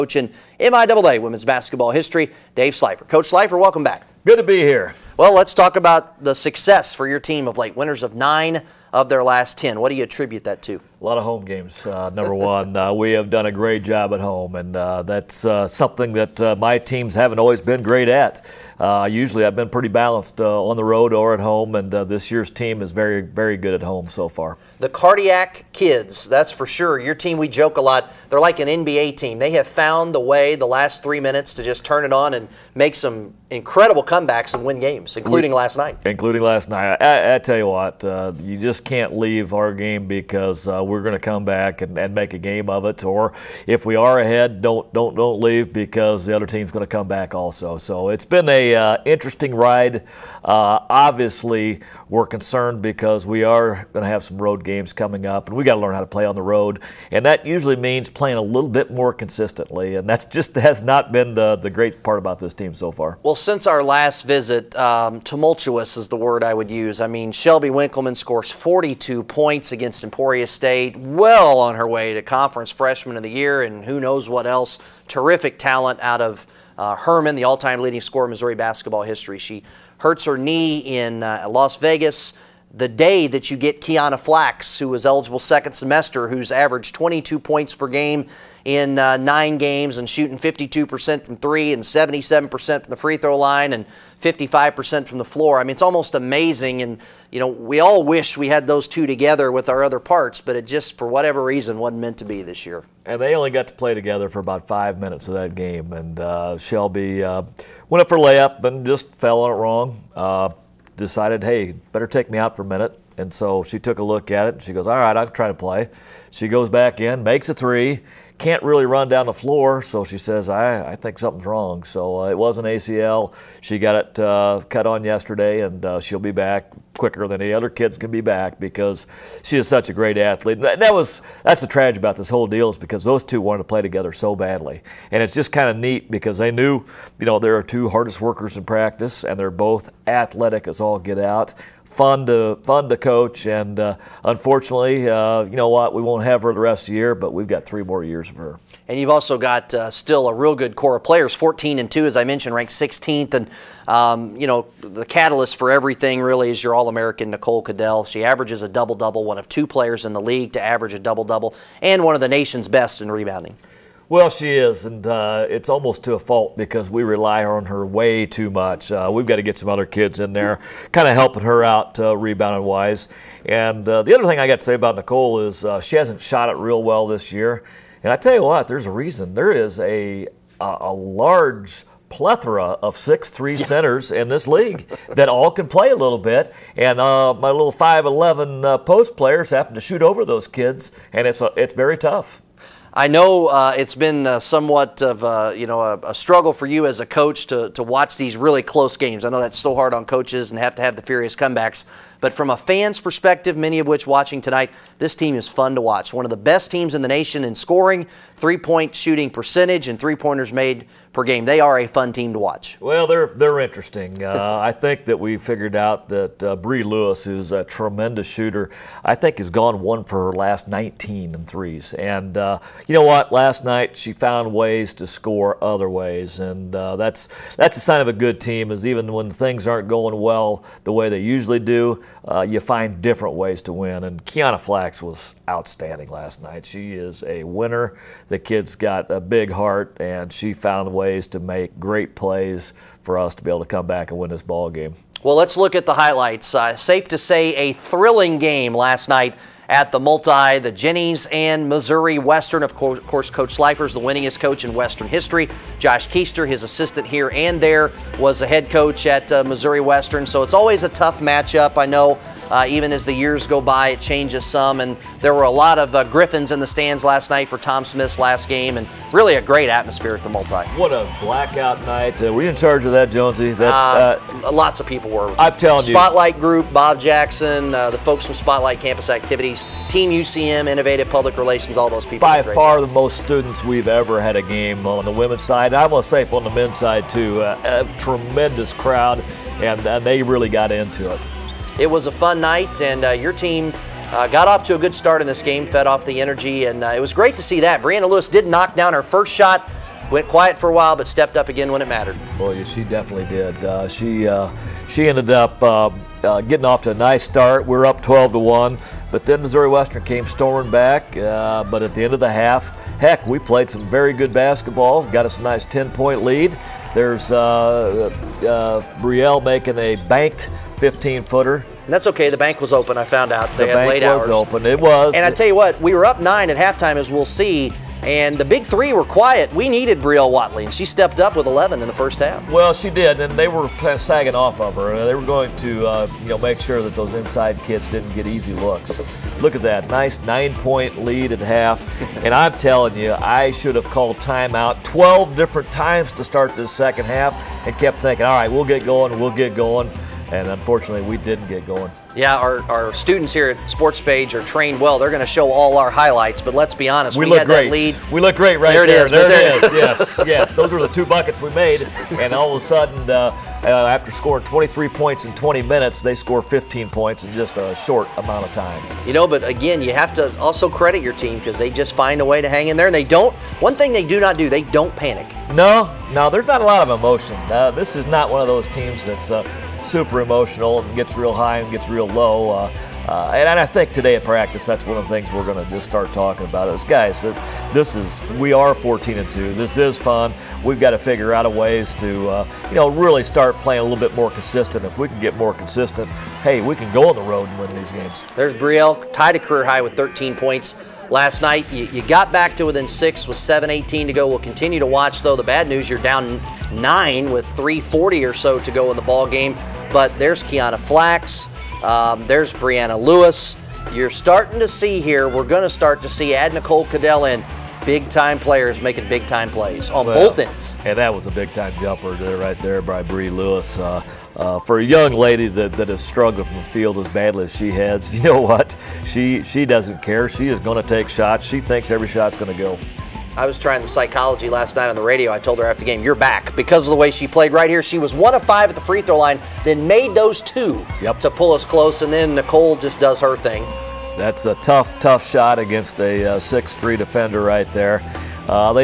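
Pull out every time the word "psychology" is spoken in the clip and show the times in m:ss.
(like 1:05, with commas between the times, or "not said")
7:13.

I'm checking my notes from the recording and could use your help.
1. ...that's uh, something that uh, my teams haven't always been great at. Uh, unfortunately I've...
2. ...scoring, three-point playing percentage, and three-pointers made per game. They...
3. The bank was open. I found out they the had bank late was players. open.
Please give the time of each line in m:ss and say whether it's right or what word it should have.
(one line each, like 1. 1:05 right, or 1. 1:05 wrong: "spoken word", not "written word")
1. 0:15 wrong: "usually", not "unfortunately"
2. 3:27 wrong: "shooting", not "playing"
3. 5:22 wrong: "hours", not "players".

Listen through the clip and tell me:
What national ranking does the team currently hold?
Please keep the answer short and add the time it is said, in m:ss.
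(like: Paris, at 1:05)
16th, at 2:32.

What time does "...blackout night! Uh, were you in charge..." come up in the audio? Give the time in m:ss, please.
4:31.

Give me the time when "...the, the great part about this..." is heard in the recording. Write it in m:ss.
1:01.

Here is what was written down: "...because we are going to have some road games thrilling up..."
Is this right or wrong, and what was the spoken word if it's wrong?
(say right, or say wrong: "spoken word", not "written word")
wrong: "coming", not "thrilling".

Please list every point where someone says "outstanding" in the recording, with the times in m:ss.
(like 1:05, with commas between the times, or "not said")
3:55.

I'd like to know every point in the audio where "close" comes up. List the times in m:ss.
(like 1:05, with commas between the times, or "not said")
3:18, 7:21.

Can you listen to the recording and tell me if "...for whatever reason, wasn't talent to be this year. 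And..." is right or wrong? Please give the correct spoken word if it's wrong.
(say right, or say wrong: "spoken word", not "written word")
wrong: "meant", not "talent".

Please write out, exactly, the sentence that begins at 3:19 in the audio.
I know that's so hard on coaches and have to have the furious comebacks.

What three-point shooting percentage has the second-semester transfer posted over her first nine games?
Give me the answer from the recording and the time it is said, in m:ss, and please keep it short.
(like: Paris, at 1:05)
52%, at 1:30.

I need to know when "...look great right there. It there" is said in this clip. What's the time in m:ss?
5:58.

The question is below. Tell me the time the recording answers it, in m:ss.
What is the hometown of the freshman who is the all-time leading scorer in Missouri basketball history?
1:16.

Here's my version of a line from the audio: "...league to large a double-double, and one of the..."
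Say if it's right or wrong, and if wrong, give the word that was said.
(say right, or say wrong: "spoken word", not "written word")
wrong: "average", not "large".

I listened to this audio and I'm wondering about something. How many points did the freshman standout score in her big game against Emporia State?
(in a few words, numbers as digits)
42.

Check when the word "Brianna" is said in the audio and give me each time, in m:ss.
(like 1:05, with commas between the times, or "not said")
4:57, 6:52.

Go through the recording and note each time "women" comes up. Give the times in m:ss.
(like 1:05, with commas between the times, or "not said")
0:01, 4:45.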